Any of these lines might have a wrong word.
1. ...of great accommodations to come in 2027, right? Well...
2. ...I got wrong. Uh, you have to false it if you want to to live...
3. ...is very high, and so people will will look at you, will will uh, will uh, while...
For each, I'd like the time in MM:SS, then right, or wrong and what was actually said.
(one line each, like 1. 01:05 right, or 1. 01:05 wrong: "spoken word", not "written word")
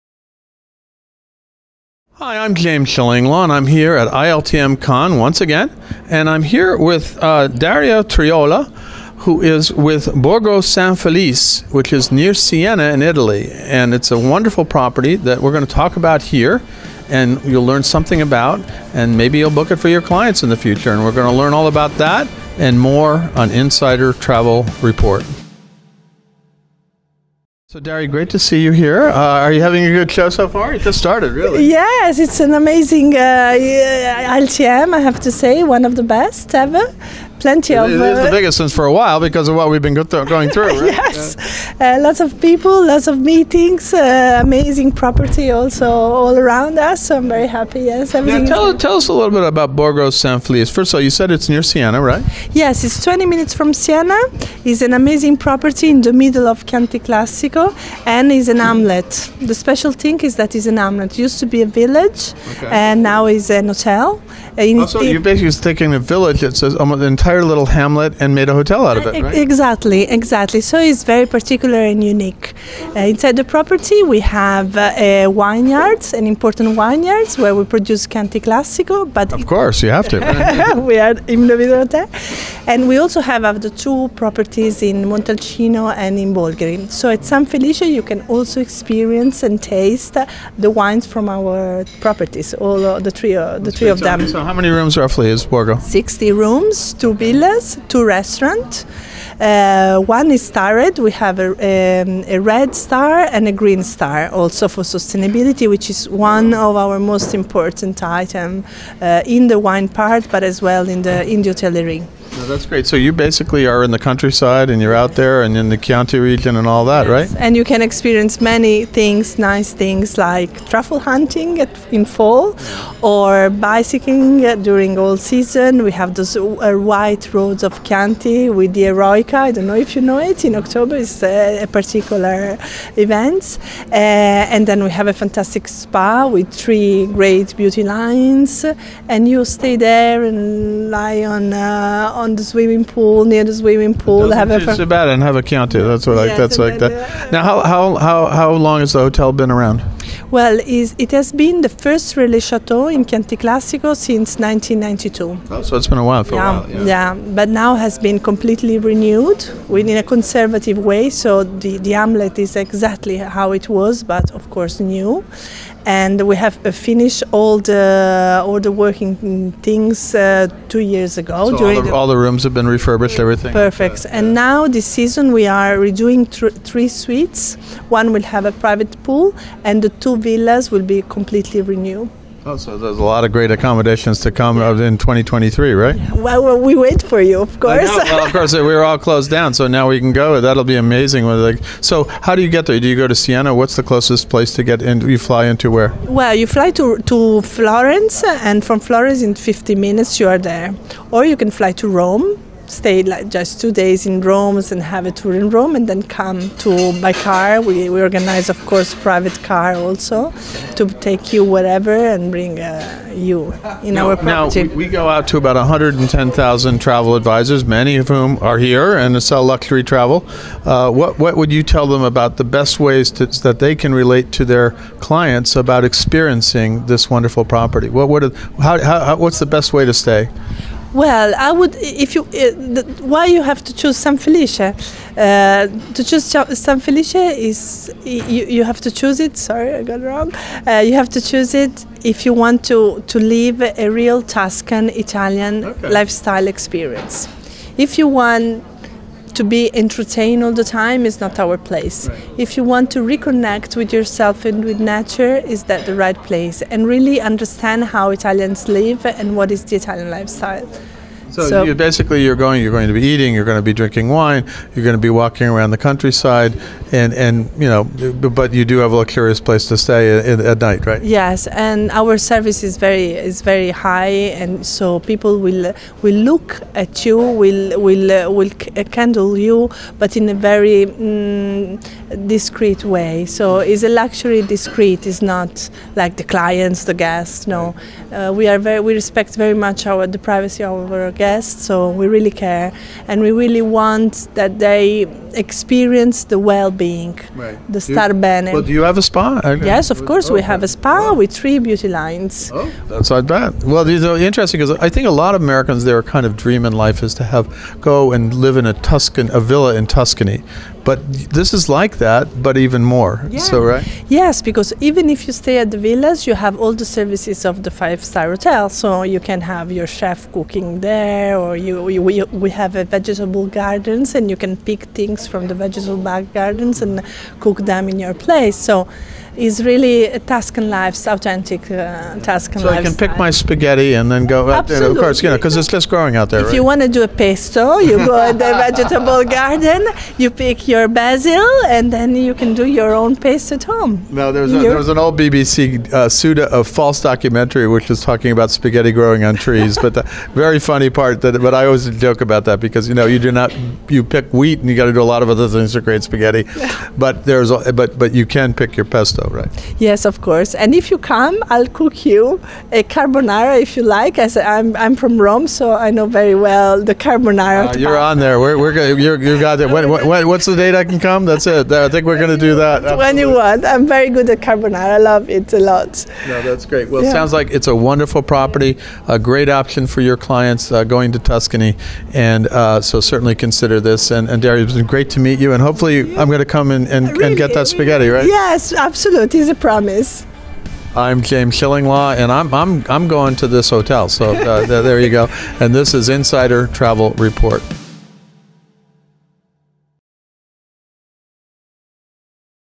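1. 03:03 wrong: "2023", not "2027"
2. 03:59 wrong: "choose", not "false"
3. 04:33 wrong: "candle", not "while".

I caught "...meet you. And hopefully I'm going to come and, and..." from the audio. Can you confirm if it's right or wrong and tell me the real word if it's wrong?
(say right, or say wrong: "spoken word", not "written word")
right.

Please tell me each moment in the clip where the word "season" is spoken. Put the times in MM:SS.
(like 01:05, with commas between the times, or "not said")
02:05, 02:54.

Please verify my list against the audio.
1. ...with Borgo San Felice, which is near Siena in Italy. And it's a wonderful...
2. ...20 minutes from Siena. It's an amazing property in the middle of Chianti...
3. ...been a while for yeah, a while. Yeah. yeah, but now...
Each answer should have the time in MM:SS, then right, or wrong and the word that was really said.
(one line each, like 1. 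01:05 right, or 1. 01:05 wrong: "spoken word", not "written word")
1. 00:09 right
2. 00:53 right
3. 02:35 right.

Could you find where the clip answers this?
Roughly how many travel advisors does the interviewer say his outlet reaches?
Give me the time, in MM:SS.
03:35.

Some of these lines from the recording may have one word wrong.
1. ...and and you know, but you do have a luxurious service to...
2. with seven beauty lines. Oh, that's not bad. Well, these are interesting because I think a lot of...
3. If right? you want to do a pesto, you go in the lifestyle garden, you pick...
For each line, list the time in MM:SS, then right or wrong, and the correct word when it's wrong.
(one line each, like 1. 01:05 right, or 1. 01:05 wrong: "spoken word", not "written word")
1. 04:26 wrong: "place", not "service"
2. 05:01 wrong: "three", not "seven"
3. 05:36 wrong: "vegetable", not "lifestyle".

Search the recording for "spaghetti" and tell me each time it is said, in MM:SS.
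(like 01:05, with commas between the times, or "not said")
05:33, 05:48, 05:56, 06:27.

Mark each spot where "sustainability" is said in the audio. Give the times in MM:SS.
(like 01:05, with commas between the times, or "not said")
01:44.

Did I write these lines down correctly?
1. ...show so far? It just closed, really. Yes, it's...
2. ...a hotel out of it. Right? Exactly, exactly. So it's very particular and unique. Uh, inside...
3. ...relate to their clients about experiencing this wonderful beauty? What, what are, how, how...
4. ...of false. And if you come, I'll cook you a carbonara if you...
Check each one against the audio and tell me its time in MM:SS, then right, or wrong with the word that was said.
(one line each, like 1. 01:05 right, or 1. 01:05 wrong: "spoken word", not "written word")
1. 00:30 wrong: "started", not "closed"
2. 01:08 right
3. 03:43 wrong: "property", not "beauty"
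4. 06:00 wrong: "course", not "false".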